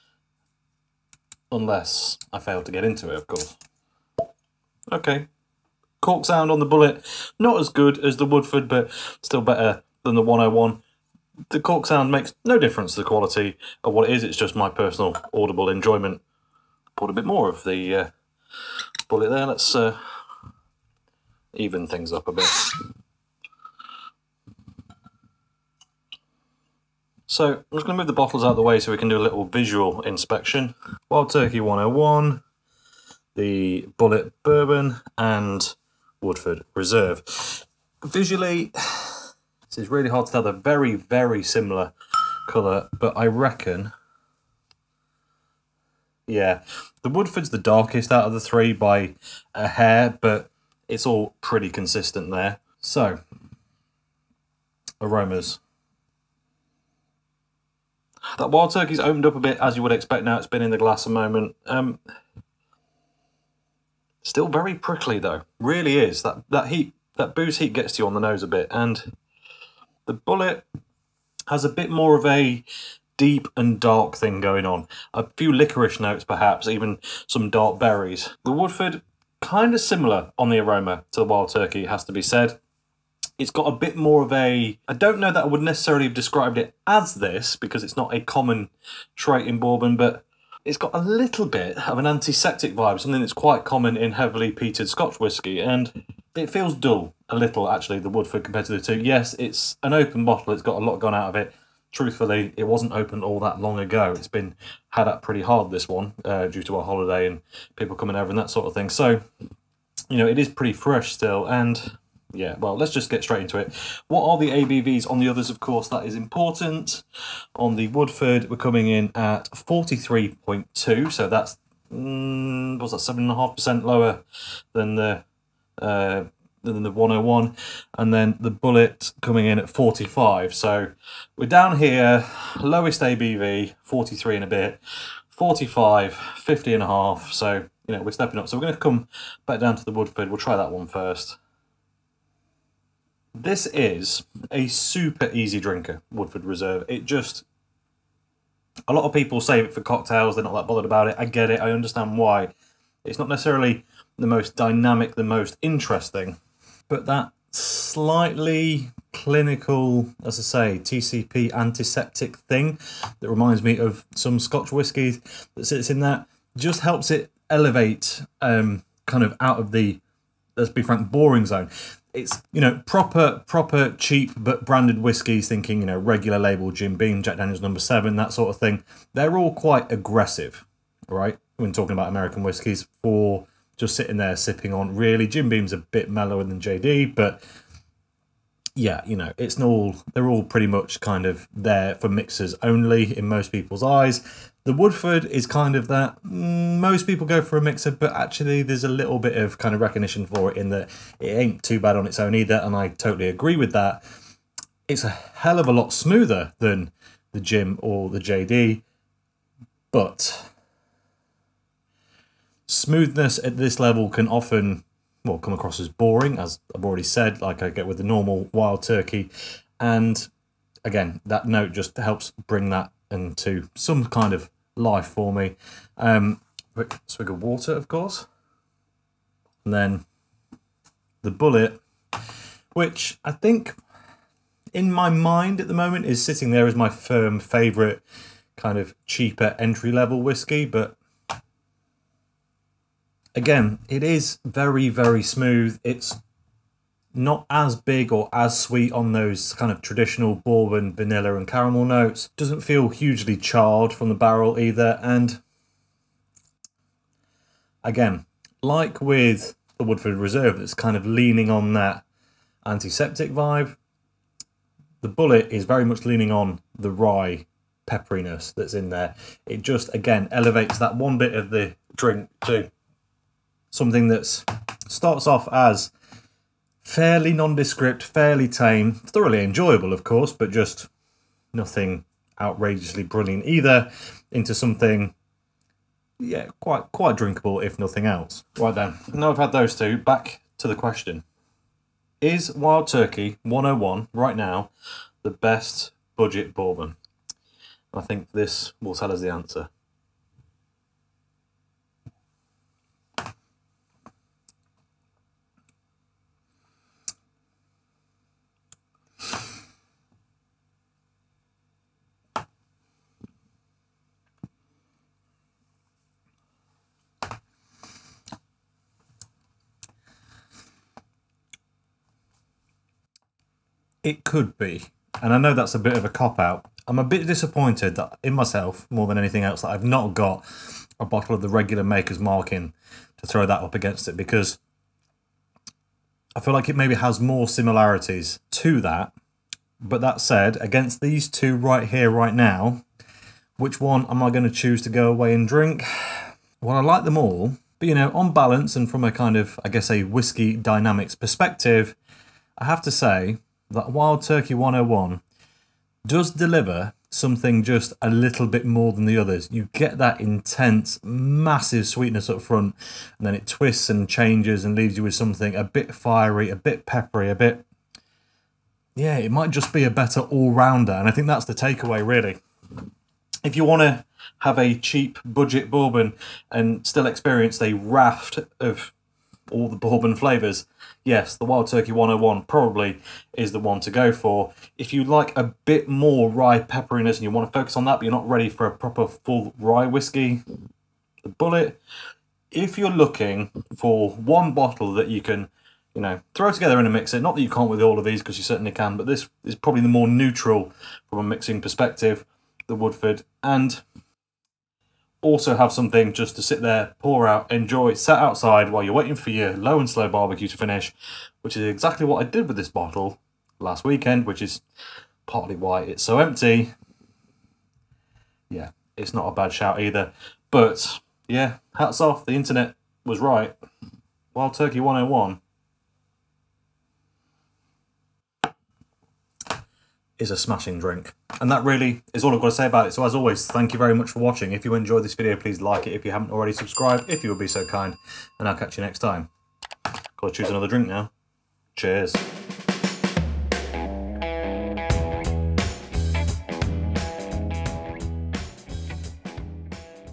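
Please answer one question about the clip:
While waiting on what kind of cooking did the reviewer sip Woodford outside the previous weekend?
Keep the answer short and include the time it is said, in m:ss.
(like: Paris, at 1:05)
low and slow barbecue, at 6:49.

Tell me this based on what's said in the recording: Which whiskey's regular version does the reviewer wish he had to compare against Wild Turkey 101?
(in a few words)
Maker's Mark.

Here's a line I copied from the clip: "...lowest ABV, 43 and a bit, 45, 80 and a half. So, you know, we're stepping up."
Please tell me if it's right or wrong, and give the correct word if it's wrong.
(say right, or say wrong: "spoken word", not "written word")
wrong: "50", not "80".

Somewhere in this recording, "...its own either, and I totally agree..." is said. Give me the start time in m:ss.
3:22.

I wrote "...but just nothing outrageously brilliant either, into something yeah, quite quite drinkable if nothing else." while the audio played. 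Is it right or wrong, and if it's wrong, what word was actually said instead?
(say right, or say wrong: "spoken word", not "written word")
right.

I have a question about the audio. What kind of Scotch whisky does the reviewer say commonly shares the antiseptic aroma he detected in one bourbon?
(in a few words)
heavily peated Scotch.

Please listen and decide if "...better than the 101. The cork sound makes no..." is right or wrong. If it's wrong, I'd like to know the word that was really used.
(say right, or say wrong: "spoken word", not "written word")
right.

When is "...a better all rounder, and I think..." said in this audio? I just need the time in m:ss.
6:09.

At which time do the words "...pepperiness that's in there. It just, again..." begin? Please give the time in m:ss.
4:27.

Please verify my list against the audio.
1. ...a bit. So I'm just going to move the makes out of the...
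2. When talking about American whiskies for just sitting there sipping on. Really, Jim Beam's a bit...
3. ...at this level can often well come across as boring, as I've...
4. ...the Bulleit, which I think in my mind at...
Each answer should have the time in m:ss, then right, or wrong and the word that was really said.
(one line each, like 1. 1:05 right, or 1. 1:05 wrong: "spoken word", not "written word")
1. 0:22 wrong: "bottles", not "makes"
2. 3:01 right
3. 3:33 right
4. 3:51 right.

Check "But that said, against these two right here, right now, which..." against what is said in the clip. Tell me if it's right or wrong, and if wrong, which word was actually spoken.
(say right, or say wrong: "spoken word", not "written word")
right.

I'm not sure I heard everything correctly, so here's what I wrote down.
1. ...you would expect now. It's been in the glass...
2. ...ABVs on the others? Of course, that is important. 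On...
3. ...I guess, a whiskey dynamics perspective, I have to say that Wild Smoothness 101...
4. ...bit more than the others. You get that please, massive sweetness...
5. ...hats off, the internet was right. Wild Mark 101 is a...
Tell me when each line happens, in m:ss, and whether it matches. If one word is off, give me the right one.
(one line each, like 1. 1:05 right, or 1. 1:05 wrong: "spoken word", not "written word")
1. 0:59 right
2. 1:54 right
3. 5:49 wrong: "Turkey", not "Smoothness"
4. 5:58 wrong: "intense", not "please"
5. 7:01 wrong: "Turkey", not "Mark".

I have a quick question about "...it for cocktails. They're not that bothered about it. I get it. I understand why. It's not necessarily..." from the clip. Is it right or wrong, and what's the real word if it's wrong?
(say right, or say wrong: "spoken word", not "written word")
right.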